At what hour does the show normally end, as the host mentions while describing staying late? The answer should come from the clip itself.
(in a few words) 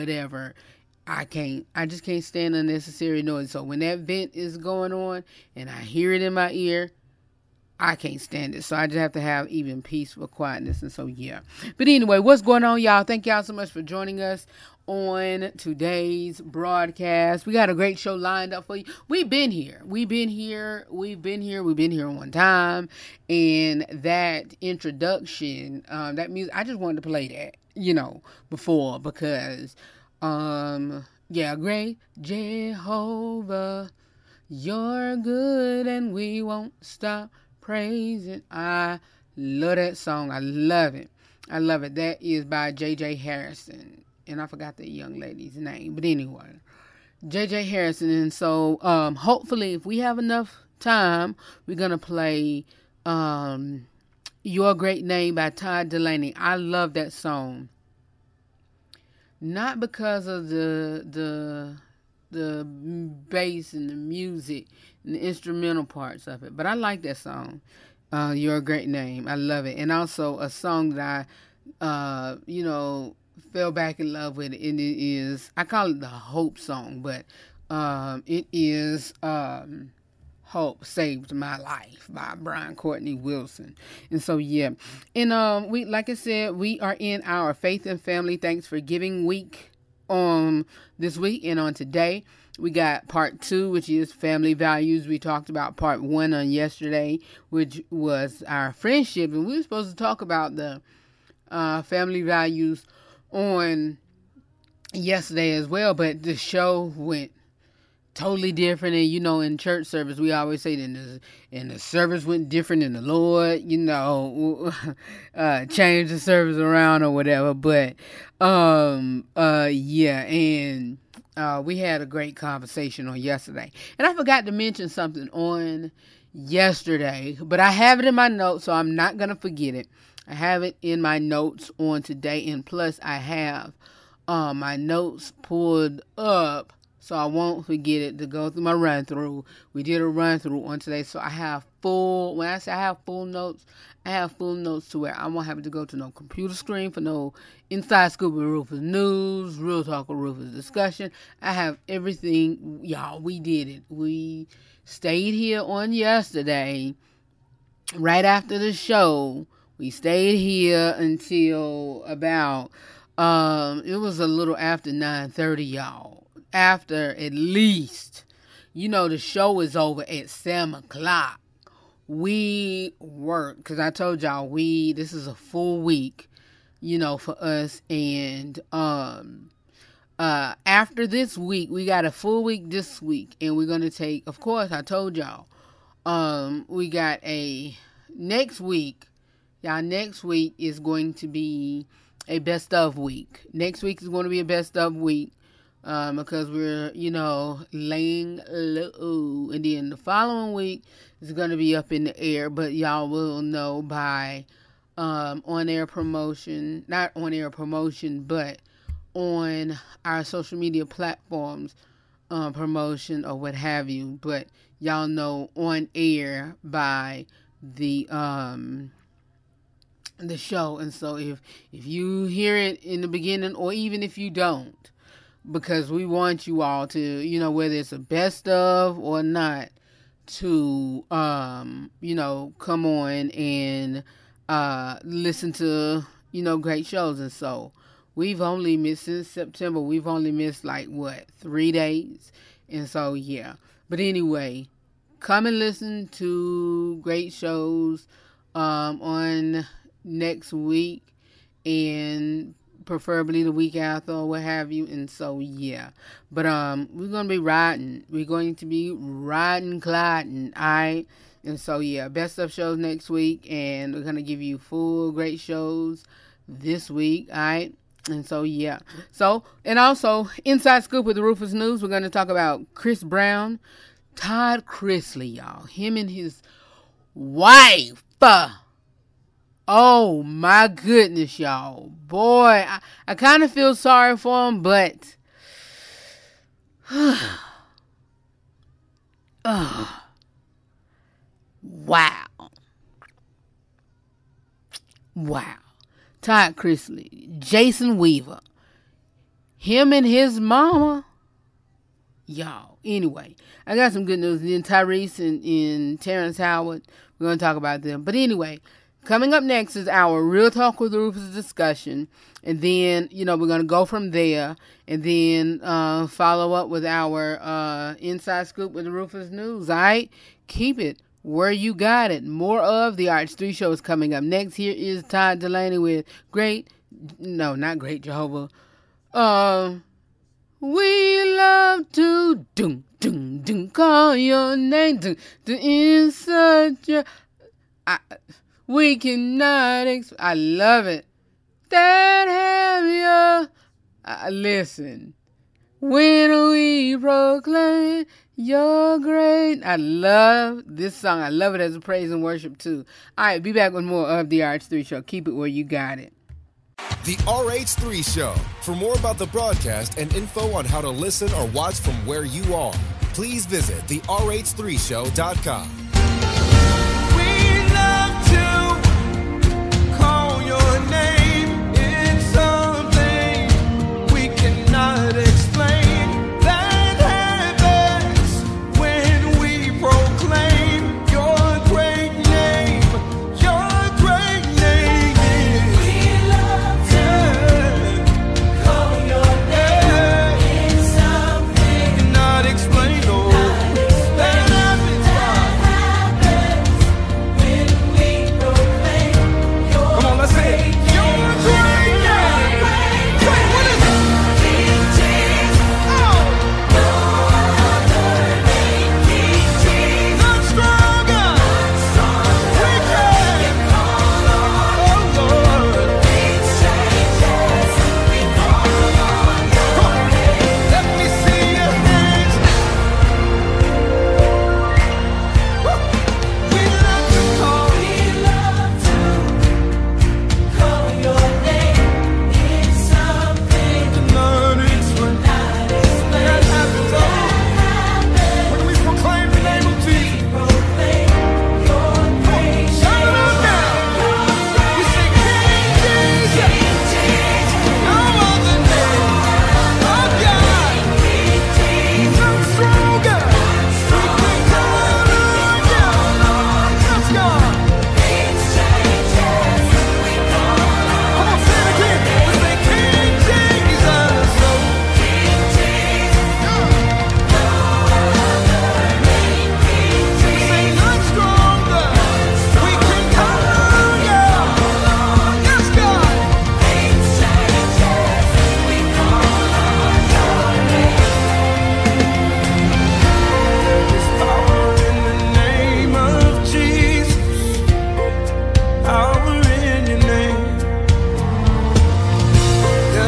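7 o'clock.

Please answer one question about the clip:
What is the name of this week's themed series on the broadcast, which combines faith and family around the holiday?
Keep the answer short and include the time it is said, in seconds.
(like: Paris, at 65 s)
Faith and Family Thanks for Giving, at 87 s.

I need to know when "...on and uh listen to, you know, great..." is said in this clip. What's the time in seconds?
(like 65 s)
232 s.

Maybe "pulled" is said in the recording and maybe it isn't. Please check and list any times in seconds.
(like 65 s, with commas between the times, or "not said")
135 s.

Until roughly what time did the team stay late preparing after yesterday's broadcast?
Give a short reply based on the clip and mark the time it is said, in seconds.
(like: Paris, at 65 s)
9:30, at 164 s.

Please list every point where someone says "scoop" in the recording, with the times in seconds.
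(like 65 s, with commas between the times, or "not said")
148 s, 270 s, 318 s.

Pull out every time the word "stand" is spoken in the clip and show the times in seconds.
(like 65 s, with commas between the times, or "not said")
2 s, 8 s.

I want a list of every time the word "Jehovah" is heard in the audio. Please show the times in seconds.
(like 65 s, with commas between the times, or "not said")
32 s, 328 s.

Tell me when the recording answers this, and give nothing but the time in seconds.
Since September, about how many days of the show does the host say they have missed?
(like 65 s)
241 s.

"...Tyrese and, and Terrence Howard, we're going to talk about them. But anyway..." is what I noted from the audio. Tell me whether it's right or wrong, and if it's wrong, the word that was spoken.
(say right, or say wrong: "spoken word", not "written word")
right.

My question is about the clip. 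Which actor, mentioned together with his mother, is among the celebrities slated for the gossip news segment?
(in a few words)
Jason Weaver.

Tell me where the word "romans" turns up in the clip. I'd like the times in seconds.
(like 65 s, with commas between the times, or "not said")
not said.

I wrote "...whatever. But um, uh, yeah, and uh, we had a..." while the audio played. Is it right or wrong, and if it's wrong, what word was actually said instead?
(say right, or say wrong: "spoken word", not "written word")
right.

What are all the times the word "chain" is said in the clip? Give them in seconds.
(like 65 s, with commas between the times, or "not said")
not said.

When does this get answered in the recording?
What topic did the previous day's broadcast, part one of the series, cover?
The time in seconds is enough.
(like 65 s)
98 s.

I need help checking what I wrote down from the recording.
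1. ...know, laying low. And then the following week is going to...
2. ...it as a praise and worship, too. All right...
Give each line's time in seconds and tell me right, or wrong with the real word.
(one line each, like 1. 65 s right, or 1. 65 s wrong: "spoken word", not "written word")
1. 197 s right
2. 351 s right.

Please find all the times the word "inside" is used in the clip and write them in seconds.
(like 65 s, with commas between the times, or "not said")
147 s, 270 s, 317 s.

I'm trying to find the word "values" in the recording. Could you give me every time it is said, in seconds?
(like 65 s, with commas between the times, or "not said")
94 s, 102 s.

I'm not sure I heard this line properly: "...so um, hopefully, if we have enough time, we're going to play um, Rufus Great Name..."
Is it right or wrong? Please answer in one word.
wrong.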